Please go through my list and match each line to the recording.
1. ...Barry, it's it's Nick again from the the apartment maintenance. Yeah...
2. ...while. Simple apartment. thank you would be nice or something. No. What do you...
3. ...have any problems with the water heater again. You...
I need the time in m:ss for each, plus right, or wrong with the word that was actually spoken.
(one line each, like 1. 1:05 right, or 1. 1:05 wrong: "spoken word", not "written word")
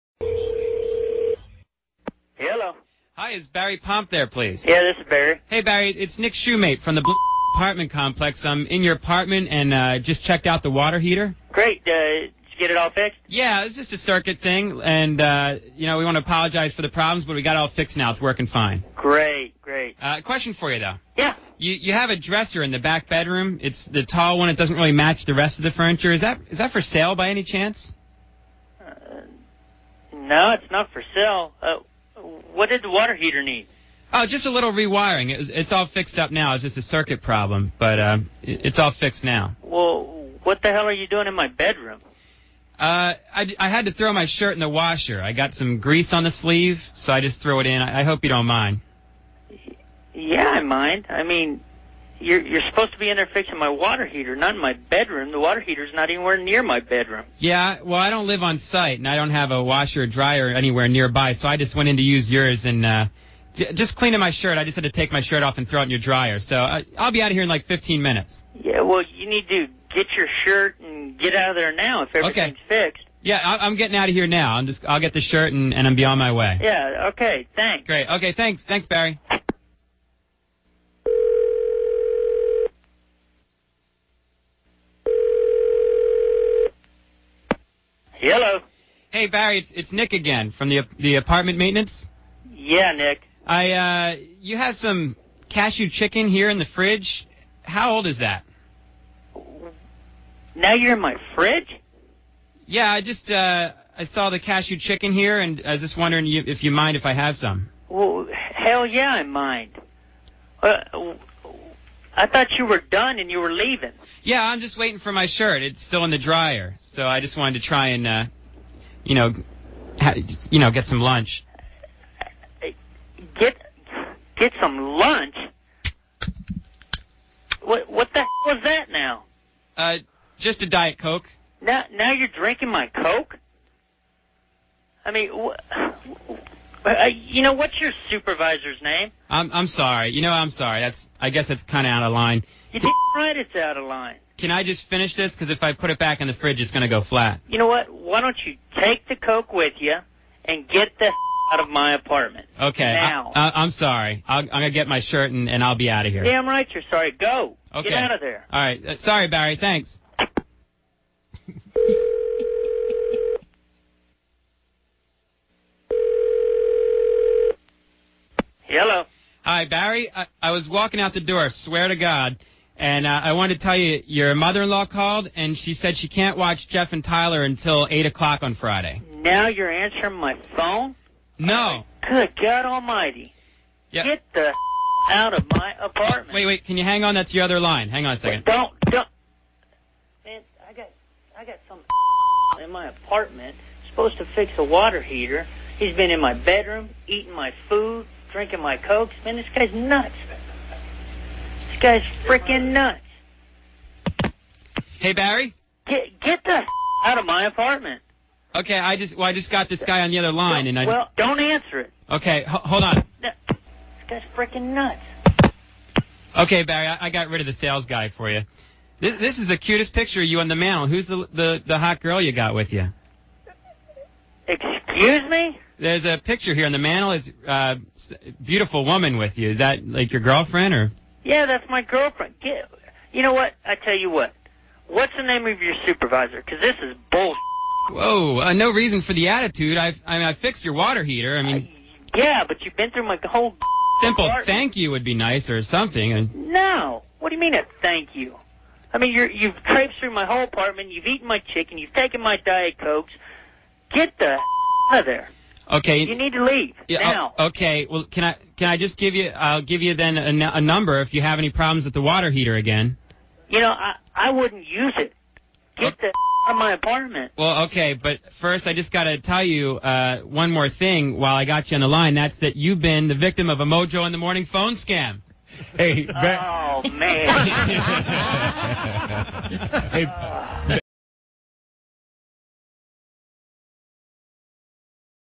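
1. 1:29 right
2. 4:03 wrong: "whole", not "while"
3. 4:21 right.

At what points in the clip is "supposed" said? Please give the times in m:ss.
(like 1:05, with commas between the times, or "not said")
0:52, 3:13.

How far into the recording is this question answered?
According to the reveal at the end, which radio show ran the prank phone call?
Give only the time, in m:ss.
4:33.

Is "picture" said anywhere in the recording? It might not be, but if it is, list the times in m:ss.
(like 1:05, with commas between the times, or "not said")
3:39, 3:46.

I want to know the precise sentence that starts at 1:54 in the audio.
Yeah, I'm just waiting for my shirt.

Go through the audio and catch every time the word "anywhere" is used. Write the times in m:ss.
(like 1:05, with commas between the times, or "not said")
0:56, 1:00.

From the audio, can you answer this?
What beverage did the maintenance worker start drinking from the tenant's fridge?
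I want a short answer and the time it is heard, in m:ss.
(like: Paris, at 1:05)
Diet Coke, at 2:10.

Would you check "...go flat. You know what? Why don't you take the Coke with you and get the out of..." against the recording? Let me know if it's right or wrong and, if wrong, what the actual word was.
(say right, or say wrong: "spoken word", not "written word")
right.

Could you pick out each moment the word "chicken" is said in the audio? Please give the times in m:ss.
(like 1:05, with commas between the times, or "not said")
1:35, 1:44, 4:11.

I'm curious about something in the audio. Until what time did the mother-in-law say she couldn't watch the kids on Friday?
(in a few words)
8 o'clock.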